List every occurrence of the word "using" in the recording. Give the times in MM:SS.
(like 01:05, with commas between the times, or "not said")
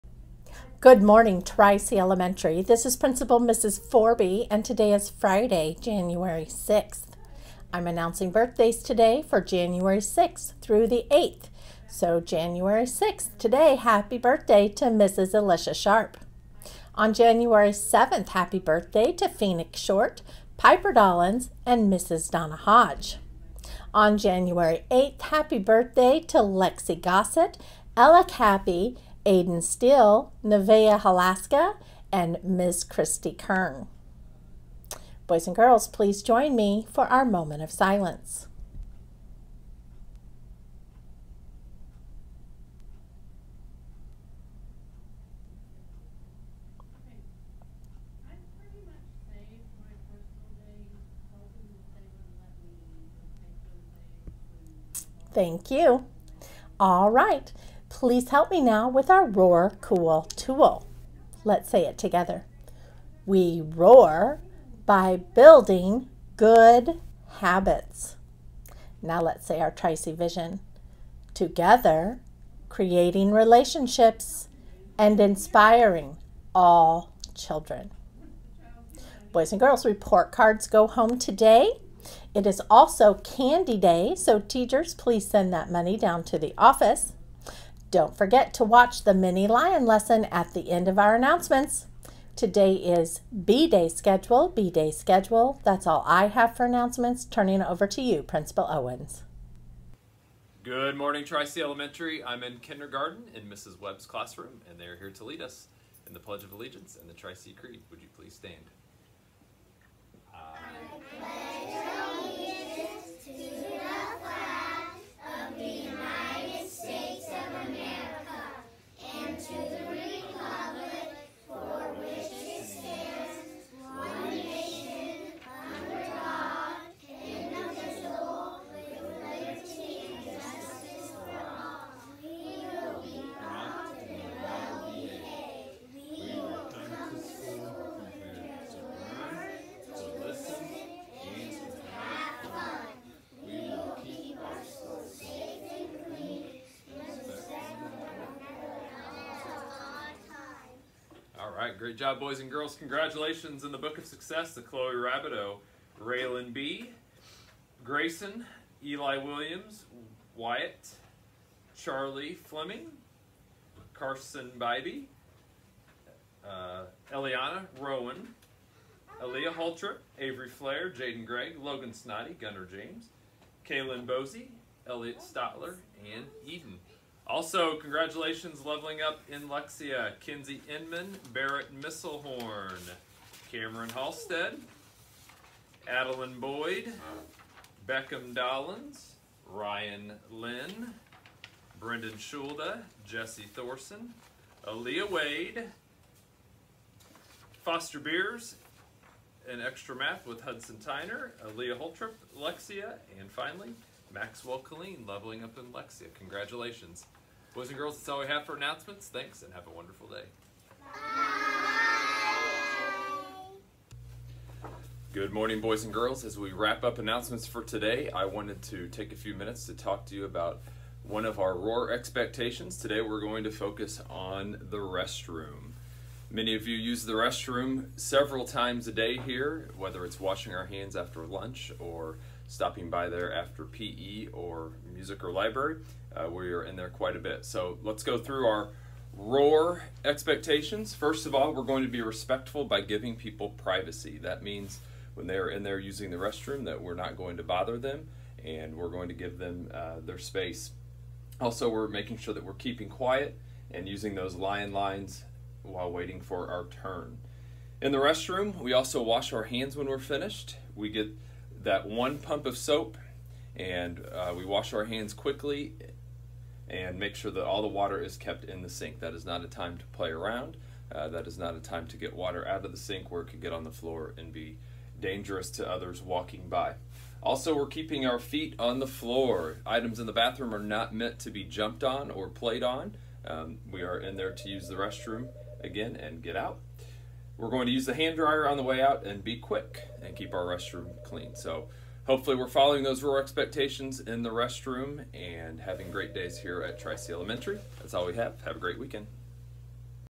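04:05, 04:13.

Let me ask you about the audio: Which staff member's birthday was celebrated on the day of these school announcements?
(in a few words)
Mrs. Alicia Sharp.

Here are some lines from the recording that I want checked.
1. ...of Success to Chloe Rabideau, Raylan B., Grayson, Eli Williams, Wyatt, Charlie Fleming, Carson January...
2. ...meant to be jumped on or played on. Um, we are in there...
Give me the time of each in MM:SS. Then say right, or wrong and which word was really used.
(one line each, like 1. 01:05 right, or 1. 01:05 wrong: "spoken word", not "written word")
1. 02:33 wrong: "Bybee", not "January"
2. 04:40 right.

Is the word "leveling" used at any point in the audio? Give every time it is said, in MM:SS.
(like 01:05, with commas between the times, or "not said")
02:58, 03:25.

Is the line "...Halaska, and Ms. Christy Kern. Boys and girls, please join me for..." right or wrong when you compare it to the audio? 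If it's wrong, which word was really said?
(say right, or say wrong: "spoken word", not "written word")
right.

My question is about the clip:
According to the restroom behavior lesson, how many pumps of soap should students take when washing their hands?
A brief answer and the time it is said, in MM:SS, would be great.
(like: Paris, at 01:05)
1, at 04:21.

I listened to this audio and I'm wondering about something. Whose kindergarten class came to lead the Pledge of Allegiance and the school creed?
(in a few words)
Mrs. Webb.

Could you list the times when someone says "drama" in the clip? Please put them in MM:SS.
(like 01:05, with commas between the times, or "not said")
not said.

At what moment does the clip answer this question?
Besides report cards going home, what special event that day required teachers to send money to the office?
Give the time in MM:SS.
01:23.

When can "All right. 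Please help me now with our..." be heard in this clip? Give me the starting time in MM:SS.
00:56.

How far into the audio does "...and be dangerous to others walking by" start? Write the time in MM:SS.
04:34.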